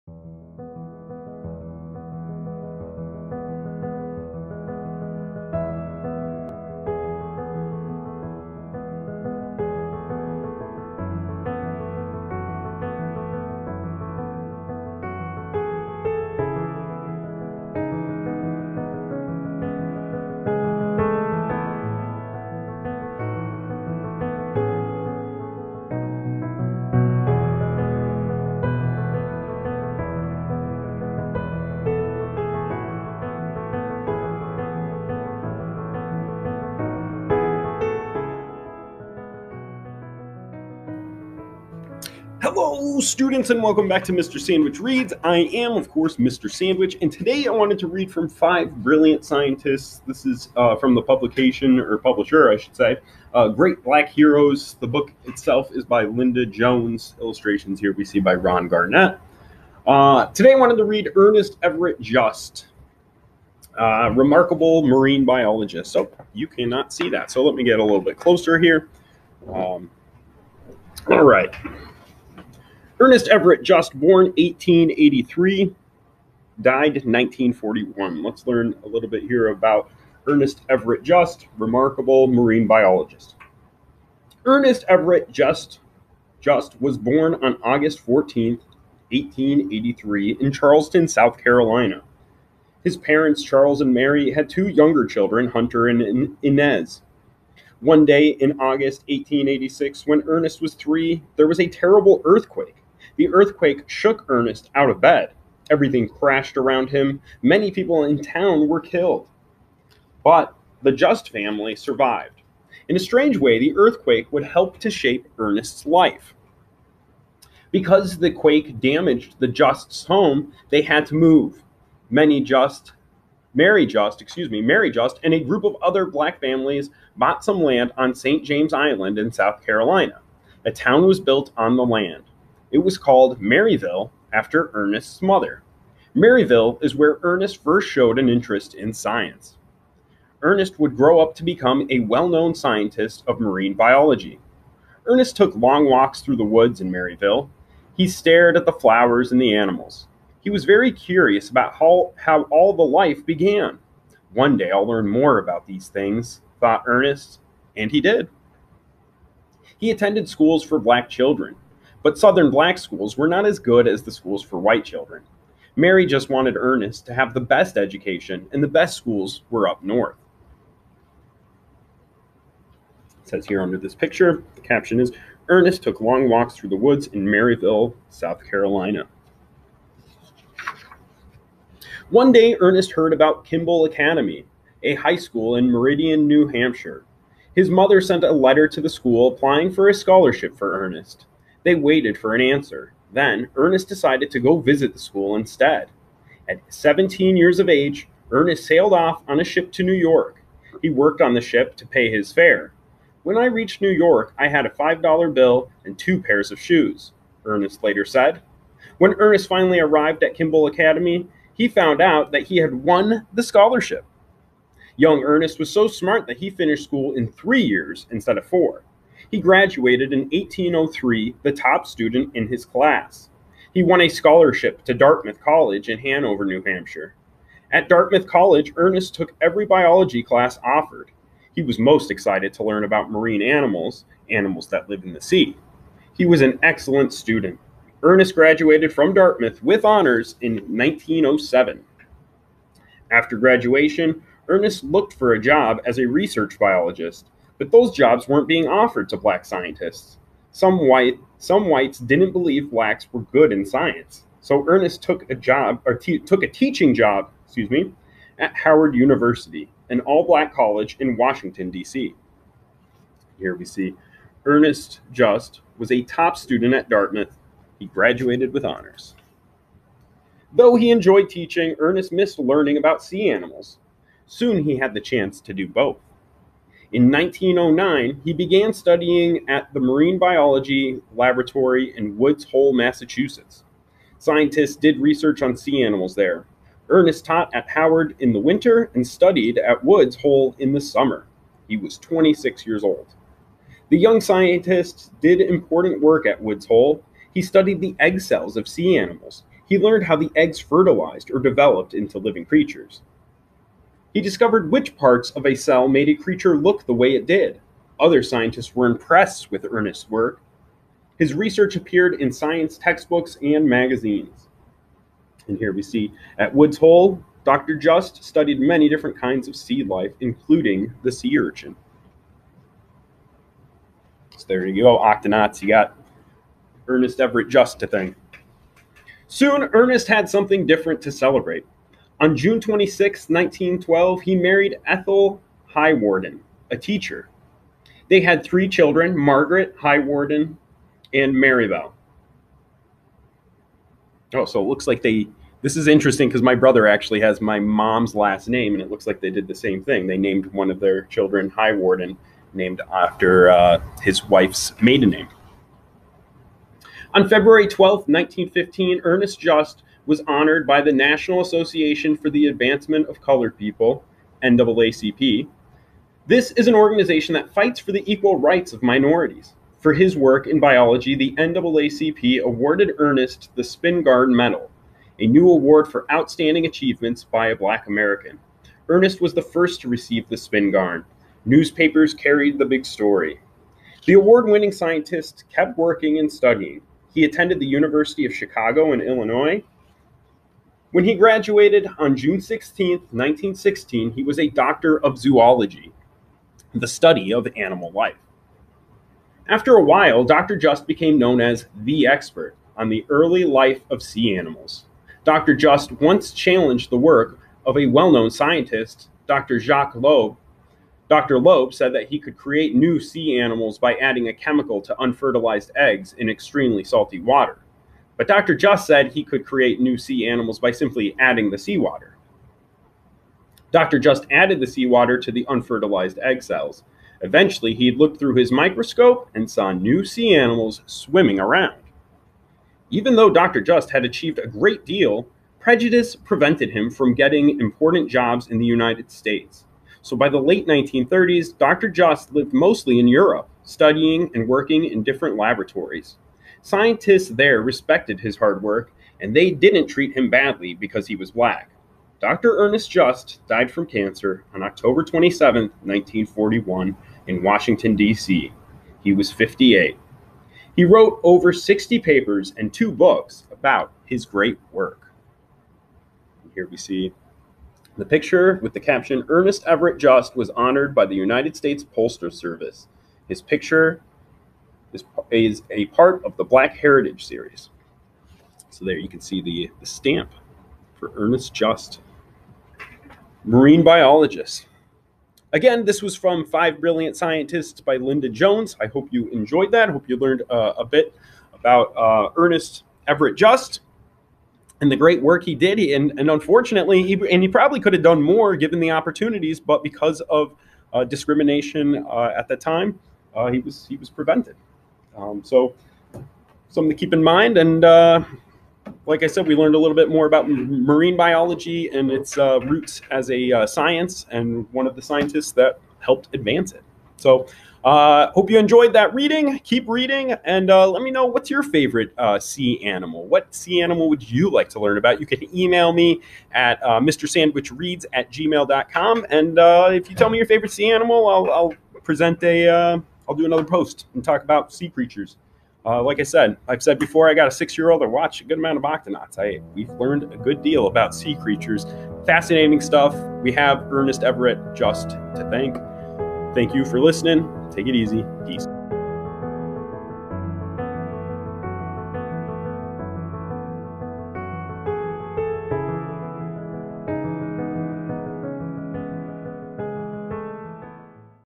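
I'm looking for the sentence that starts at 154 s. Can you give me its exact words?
One day I'll learn more about these things, thought Ernest, and he did.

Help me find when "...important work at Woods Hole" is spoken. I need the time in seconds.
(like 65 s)
295 s.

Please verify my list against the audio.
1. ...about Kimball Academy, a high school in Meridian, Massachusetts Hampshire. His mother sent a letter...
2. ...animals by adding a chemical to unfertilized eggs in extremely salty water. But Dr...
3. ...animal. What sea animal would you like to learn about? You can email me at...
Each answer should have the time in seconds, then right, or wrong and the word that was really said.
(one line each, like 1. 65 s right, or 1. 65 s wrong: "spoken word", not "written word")
1. 183 s wrong: "New", not "Massachusetts"
2. 413 s right
3. 522 s right.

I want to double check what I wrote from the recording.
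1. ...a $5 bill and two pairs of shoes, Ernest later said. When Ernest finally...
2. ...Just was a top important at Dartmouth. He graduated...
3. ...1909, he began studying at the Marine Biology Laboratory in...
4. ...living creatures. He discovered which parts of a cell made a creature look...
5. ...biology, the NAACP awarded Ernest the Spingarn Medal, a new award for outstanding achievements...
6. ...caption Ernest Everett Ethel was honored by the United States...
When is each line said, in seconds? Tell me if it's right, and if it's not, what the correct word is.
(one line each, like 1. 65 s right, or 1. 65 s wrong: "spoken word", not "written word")
1. 204 s right
2. 265 s wrong: "student", not "important"
3. 277 s right
4. 302 s right
5. 370 s right
6. 468 s wrong: "Just", not "Ethel".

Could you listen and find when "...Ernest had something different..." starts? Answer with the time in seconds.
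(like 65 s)
329 s.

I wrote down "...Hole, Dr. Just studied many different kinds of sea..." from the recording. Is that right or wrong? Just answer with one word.
right.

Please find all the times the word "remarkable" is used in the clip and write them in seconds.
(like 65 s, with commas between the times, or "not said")
64 s, 81 s.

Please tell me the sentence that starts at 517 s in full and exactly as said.
So uh, hope you enjoyed that reading.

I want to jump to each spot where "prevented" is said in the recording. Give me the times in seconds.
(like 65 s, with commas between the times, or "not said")
436 s, 504 s.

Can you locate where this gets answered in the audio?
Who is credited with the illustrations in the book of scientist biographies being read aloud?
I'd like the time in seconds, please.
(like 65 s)
58 s.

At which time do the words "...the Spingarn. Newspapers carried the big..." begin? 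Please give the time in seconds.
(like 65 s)
380 s.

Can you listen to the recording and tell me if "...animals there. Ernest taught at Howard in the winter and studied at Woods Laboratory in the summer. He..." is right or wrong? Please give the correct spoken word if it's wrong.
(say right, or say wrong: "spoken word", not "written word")
wrong: "Hole", not "Laboratory".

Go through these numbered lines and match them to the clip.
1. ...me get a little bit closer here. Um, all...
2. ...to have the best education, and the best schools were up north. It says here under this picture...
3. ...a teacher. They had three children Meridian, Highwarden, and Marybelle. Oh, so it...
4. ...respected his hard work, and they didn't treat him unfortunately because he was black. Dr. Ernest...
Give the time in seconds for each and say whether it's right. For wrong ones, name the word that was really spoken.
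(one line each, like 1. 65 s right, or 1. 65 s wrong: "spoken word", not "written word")
1. 67 s right
2. 167 s right
3. 336 s wrong: "Margaret", not "Meridian"
4. 447 s wrong: "badly", not "unfortunately".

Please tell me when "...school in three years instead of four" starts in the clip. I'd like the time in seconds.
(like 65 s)
216 s.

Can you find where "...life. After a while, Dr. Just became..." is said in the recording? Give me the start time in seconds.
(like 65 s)
397 s.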